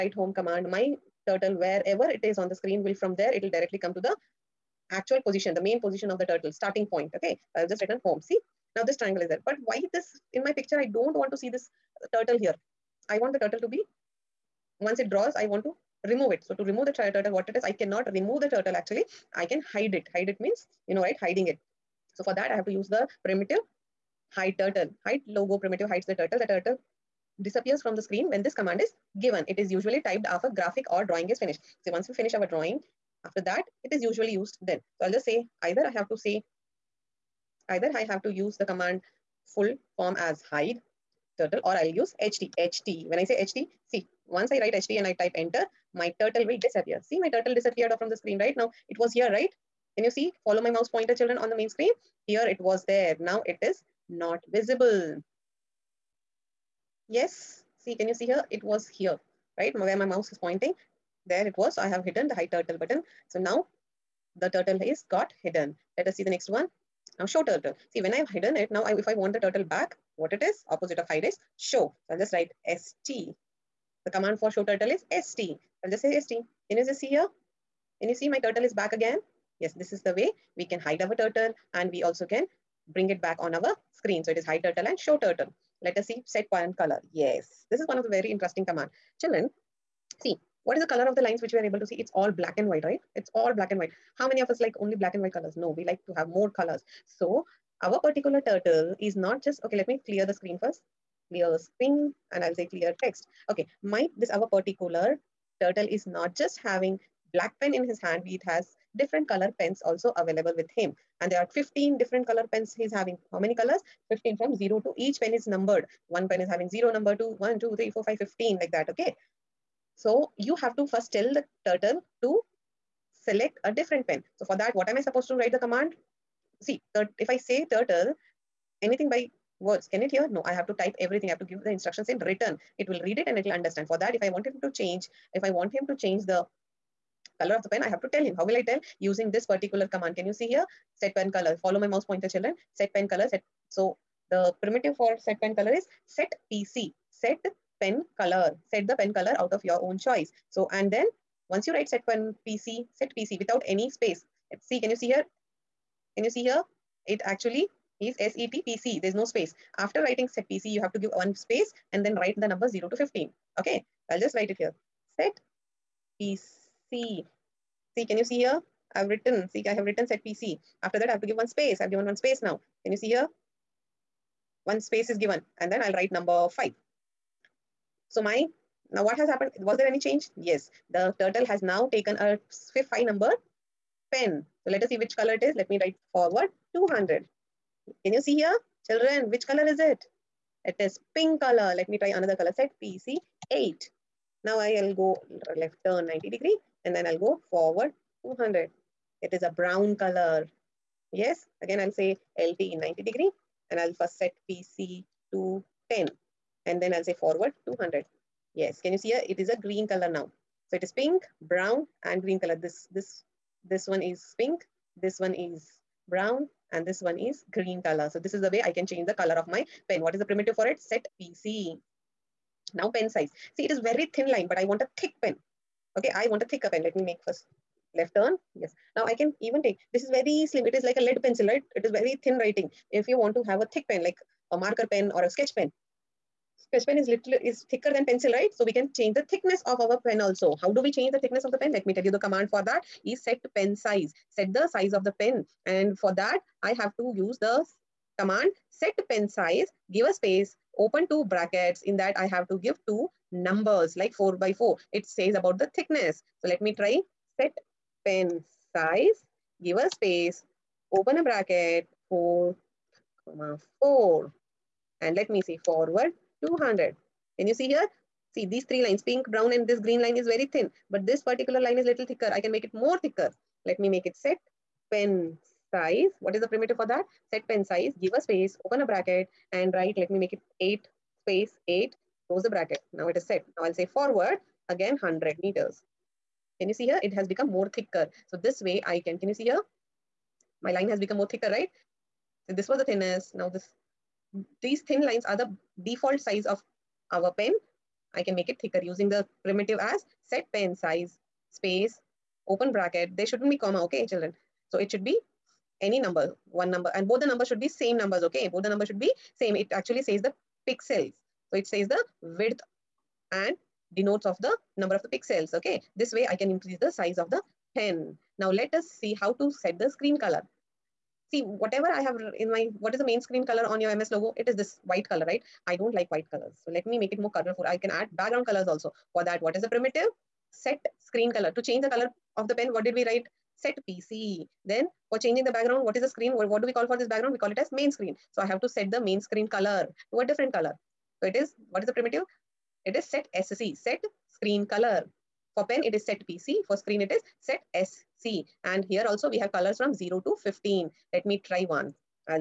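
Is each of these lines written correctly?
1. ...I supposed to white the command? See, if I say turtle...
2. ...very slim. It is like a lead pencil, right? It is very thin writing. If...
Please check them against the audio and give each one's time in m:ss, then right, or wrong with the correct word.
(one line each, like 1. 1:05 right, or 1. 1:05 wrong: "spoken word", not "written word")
1. 2:04 wrong: "write", not "white"
2. 3:50 right.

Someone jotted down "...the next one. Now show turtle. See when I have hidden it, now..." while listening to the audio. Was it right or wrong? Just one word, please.
right.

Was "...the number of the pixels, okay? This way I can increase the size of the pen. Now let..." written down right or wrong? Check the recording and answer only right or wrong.
right.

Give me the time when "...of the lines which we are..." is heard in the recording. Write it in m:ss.
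1:31.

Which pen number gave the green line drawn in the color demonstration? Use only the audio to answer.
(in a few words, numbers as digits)
10.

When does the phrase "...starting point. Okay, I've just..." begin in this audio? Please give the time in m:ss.
0:06.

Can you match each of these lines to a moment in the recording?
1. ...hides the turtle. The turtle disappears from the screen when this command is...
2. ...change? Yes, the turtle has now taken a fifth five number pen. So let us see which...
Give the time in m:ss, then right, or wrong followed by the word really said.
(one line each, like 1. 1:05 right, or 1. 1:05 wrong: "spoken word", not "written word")
1. 0:25 right
2. 2:59 right.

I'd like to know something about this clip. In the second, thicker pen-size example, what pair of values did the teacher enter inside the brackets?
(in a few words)
8 8.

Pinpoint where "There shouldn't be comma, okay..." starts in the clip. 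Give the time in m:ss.
5:03.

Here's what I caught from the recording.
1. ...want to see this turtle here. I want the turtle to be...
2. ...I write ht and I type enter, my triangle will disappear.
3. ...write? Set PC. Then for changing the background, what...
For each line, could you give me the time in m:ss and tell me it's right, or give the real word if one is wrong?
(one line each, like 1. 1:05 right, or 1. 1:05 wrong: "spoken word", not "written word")
1. 0:11 right
2. 0:44 wrong: "turtle", not "triangle"
3. 5:33 right.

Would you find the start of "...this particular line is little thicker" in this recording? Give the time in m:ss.
4:31.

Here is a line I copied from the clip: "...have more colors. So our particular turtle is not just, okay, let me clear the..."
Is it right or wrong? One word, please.
right.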